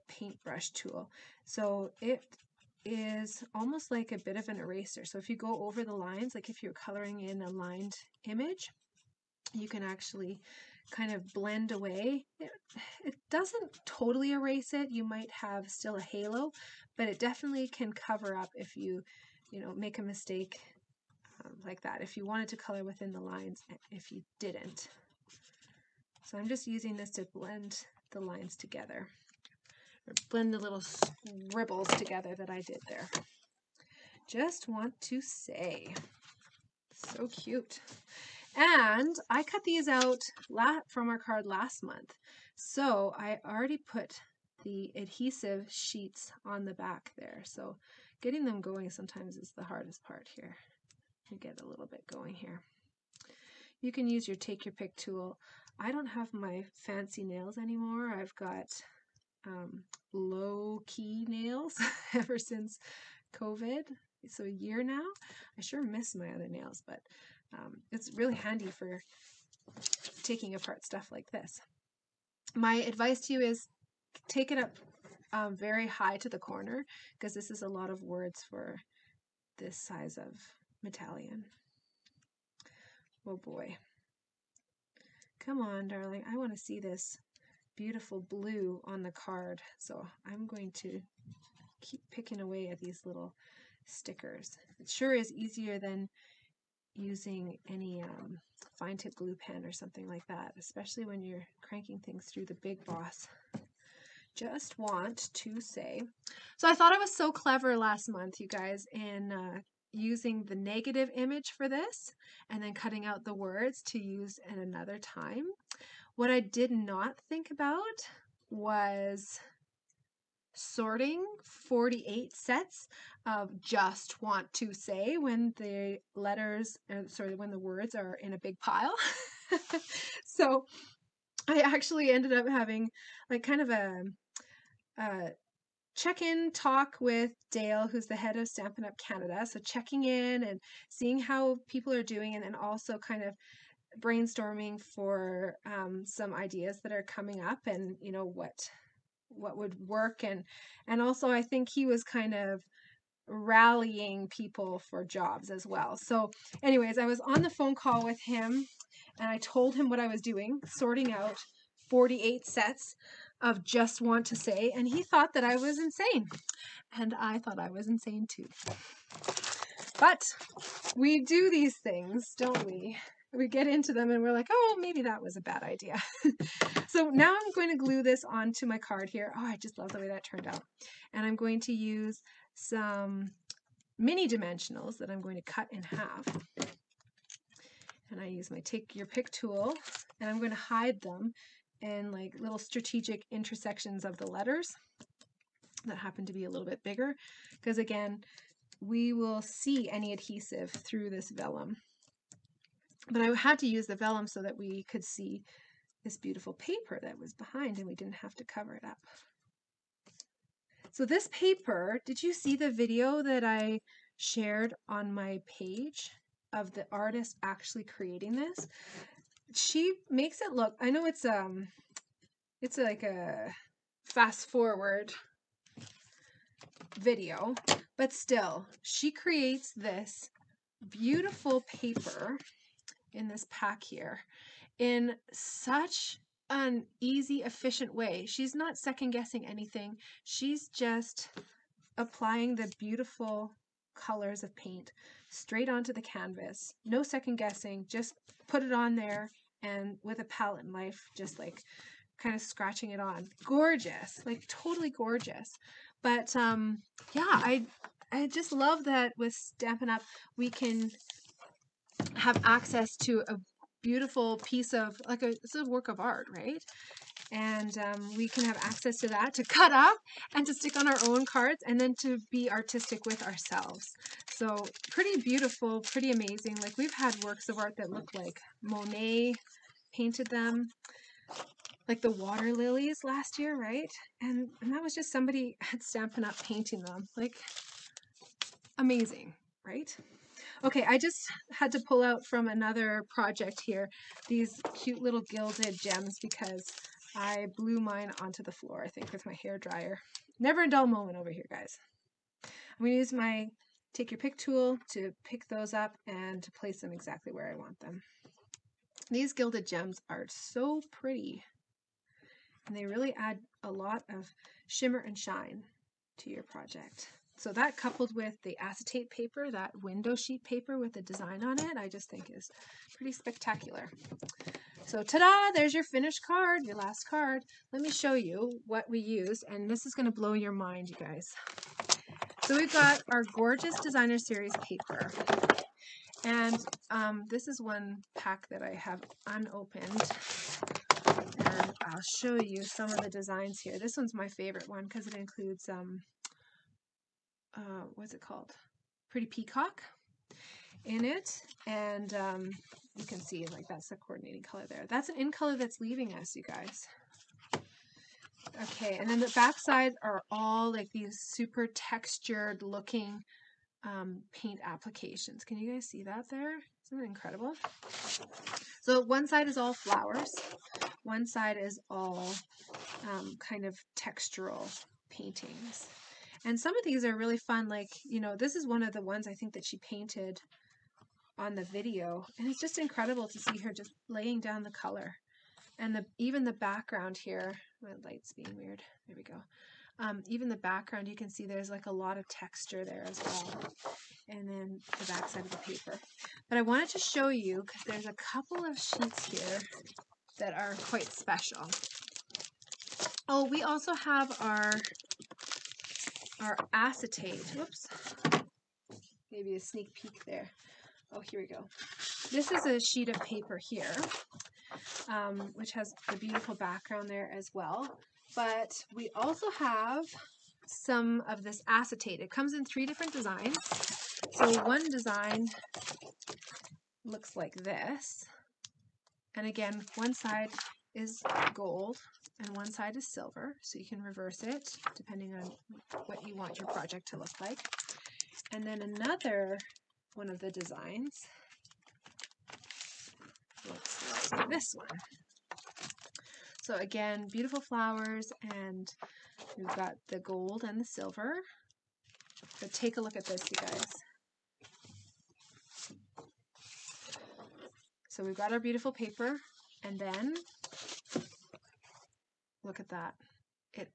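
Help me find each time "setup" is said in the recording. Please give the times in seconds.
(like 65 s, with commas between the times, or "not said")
not said.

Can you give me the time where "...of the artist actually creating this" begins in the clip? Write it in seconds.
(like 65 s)
216 s.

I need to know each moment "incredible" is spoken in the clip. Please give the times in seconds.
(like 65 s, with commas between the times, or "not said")
367 s, 382 s.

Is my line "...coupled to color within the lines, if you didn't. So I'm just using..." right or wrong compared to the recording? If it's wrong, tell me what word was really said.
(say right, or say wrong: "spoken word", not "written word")
wrong: "wanted", not "coupled".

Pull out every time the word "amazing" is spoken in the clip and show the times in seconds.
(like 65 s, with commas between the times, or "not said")
276 s, 288 s.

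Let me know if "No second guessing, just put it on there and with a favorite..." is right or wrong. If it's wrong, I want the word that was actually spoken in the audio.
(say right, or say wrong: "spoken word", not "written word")
wrong: "palette", not "favorite".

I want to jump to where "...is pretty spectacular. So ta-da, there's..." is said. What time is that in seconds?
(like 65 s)
322 s.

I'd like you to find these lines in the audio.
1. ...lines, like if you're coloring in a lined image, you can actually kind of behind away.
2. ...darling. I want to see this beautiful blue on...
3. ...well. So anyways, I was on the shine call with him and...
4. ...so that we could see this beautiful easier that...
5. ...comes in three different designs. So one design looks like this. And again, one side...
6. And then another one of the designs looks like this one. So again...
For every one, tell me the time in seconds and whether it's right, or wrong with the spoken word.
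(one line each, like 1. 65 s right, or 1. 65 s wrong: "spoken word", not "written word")
1. 5 s wrong: "blend", not "behind"
2. 85 s right
3. 155 s wrong: "phone", not "shine"
4. 204 s wrong: "paper", not "easier"
5. 422 s right
6. 438 s right.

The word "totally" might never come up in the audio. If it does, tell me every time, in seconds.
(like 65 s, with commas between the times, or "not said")
13 s, 254 s.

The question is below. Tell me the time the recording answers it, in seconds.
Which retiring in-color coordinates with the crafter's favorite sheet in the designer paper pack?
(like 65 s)
349 s.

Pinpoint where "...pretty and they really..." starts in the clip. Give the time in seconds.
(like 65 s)
310 s.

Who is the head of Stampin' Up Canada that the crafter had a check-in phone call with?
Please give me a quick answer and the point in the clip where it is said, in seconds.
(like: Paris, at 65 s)
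Dale, at 137 s.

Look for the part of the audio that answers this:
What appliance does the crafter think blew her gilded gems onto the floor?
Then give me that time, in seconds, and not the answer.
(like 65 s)
299 s.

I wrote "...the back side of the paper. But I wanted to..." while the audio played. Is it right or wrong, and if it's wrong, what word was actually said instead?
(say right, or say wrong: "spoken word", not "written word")
right.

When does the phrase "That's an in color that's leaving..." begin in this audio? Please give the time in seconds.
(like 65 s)
354 s.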